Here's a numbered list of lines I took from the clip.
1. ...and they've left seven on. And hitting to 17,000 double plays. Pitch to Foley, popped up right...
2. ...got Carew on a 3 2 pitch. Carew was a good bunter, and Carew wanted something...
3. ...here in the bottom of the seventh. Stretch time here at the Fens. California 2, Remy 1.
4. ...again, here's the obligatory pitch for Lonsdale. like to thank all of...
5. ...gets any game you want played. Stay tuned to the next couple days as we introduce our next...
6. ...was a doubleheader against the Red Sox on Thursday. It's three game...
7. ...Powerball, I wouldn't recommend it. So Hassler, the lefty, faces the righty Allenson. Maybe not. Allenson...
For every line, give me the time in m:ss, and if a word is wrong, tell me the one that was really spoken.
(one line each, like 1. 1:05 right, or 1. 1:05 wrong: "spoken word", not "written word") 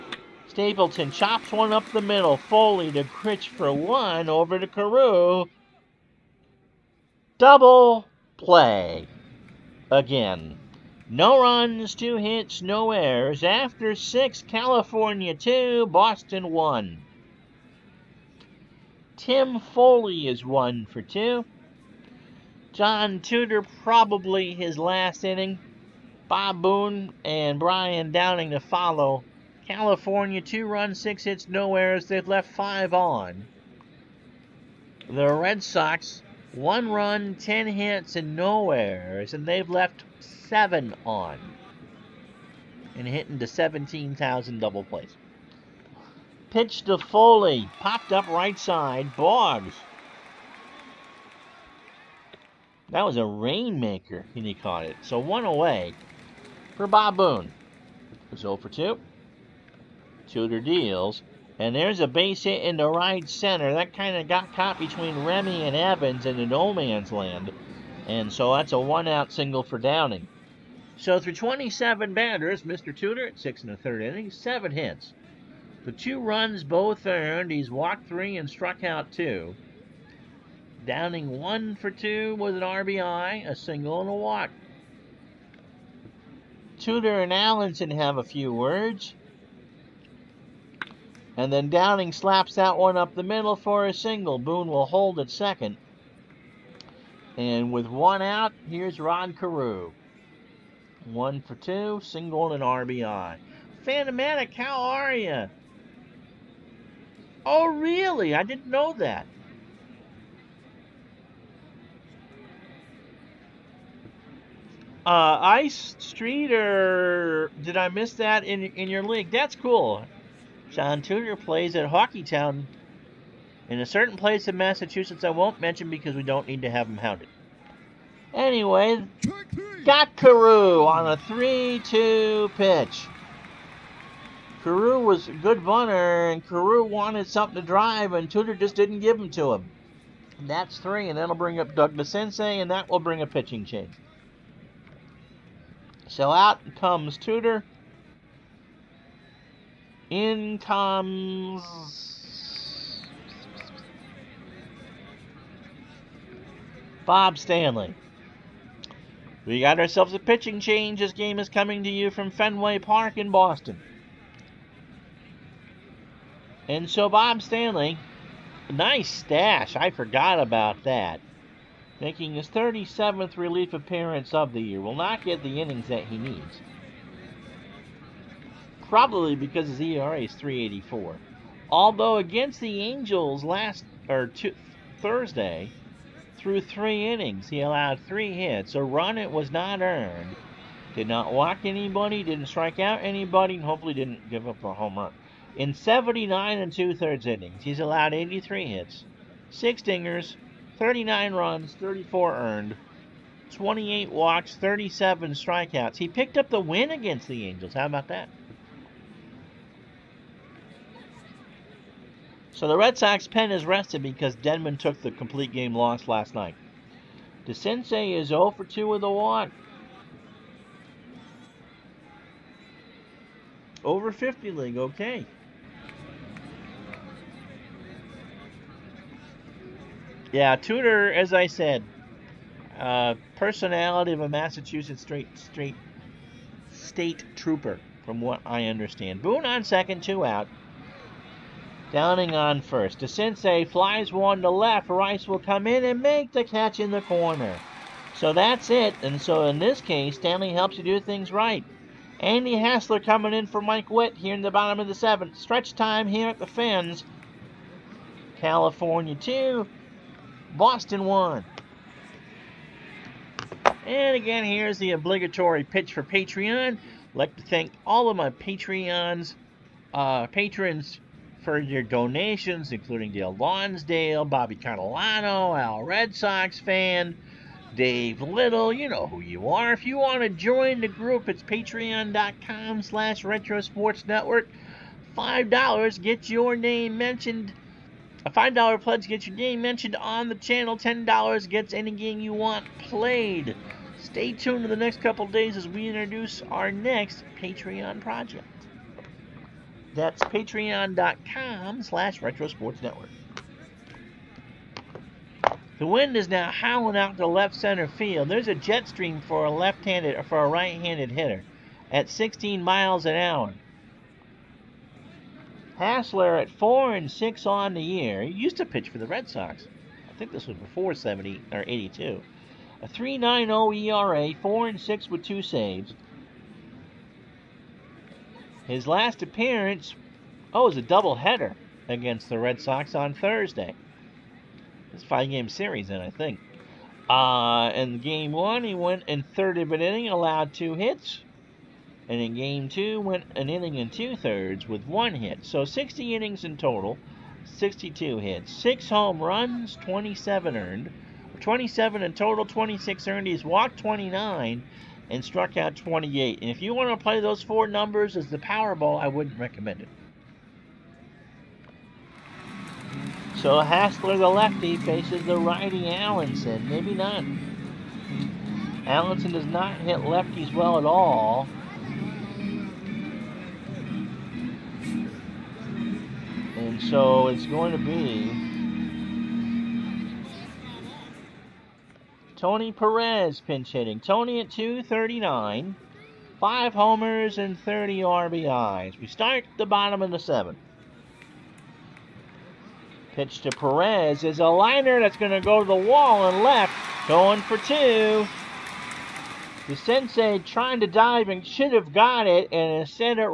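1. 0:39 right
2. 2:09 right
3. 4:14 wrong: "Boston", not "Remy"
4. 4:24 wrong: "Patreon", not "Lonsdale"
5. 4:51 right
6. 5:30 wrong: "five", not "three"
7. 5:58 right.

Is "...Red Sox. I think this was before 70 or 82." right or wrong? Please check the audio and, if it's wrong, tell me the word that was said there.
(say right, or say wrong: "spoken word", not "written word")
right.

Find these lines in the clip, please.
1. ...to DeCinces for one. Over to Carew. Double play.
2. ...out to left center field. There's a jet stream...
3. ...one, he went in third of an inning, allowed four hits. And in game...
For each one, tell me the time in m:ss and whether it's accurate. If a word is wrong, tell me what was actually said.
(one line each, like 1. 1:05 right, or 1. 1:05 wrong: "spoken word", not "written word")
1. 0:02 wrong: "Grich", not "DeCinces"
2. 5:06 right
3. 5:38 wrong: "two", not "four".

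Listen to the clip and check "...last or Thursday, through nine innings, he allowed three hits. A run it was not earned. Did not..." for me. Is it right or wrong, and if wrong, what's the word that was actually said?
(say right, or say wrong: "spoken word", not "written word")
wrong: "three", not "nine".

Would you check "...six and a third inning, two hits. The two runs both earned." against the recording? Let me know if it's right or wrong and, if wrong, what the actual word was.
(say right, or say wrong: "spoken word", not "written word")
wrong: "seven", not "two".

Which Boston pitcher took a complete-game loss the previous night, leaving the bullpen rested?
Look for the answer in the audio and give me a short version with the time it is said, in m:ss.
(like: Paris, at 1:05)
Denman, at 3:34.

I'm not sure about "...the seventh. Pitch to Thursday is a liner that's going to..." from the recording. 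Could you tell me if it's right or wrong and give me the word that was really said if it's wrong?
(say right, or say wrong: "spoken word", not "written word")
wrong: "Perez", not "Thursday".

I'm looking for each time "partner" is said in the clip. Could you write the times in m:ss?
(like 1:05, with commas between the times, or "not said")
not said.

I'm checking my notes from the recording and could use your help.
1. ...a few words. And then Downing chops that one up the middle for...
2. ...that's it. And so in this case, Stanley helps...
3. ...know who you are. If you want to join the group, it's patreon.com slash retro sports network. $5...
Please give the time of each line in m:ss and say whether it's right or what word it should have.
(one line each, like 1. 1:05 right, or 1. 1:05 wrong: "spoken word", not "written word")
1. 1:28 wrong: "slaps", not "chops"
2. 4:08 right
3. 4:38 right.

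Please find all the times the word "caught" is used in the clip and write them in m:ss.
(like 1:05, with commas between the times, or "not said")
0:54, 1:04.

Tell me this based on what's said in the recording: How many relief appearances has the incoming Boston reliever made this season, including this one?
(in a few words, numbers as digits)
37.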